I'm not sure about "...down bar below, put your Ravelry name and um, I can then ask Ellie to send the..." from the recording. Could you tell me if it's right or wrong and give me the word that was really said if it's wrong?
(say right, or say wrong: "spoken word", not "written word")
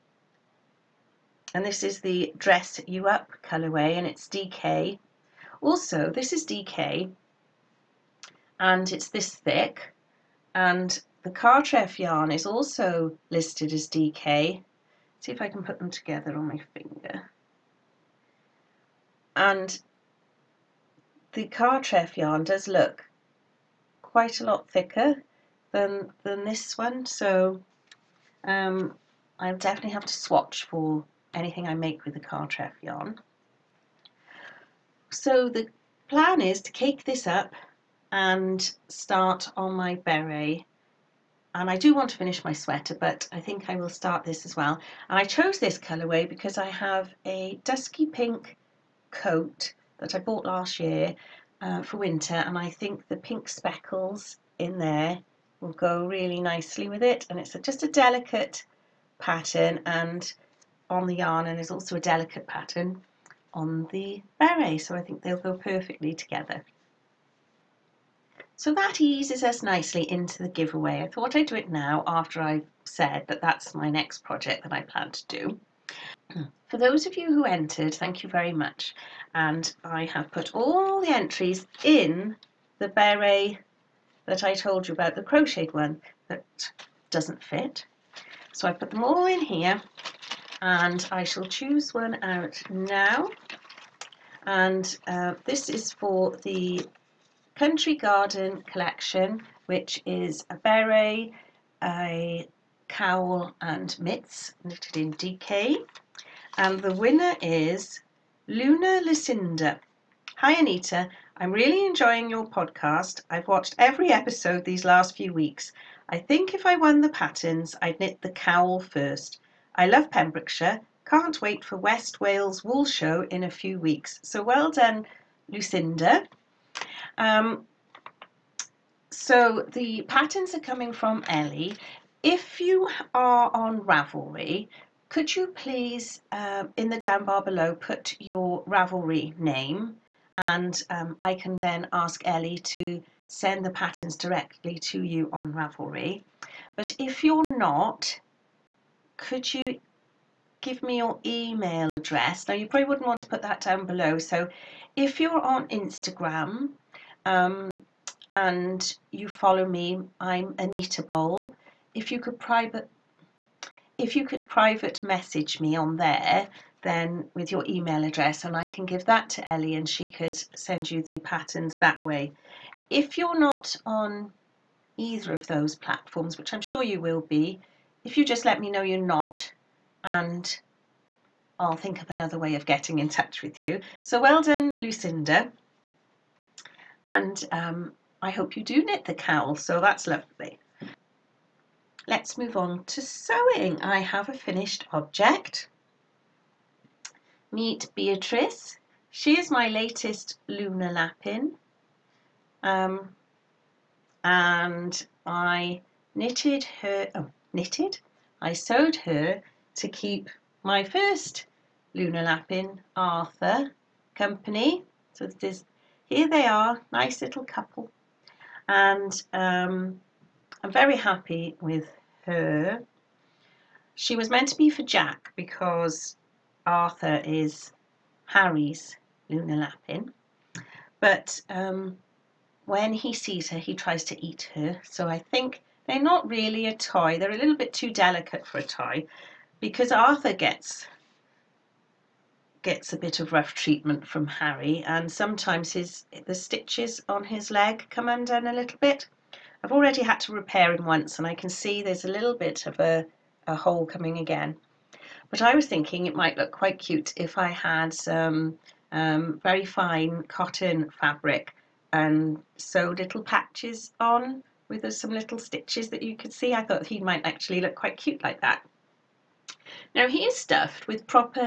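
right.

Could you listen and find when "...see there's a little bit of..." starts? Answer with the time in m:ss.
4:11.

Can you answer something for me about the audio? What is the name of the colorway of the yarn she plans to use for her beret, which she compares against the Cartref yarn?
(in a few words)
Dress You Up.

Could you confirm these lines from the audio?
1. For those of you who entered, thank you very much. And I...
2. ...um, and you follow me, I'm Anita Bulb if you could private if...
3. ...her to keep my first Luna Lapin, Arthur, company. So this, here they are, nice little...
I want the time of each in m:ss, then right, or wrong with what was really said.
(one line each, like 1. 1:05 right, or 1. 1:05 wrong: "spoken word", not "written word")
1. 1:16 right
2. 2:37 right
3. 3:28 right.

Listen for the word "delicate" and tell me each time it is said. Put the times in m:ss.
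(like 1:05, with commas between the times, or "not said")
0:57, 1:01, 3:57.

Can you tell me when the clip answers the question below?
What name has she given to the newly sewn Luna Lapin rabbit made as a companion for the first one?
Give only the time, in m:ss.
3:17.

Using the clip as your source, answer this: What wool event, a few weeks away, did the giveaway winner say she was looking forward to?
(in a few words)
West Wales Wool Show.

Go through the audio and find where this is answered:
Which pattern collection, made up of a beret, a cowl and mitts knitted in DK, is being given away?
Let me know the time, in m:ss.
1:37.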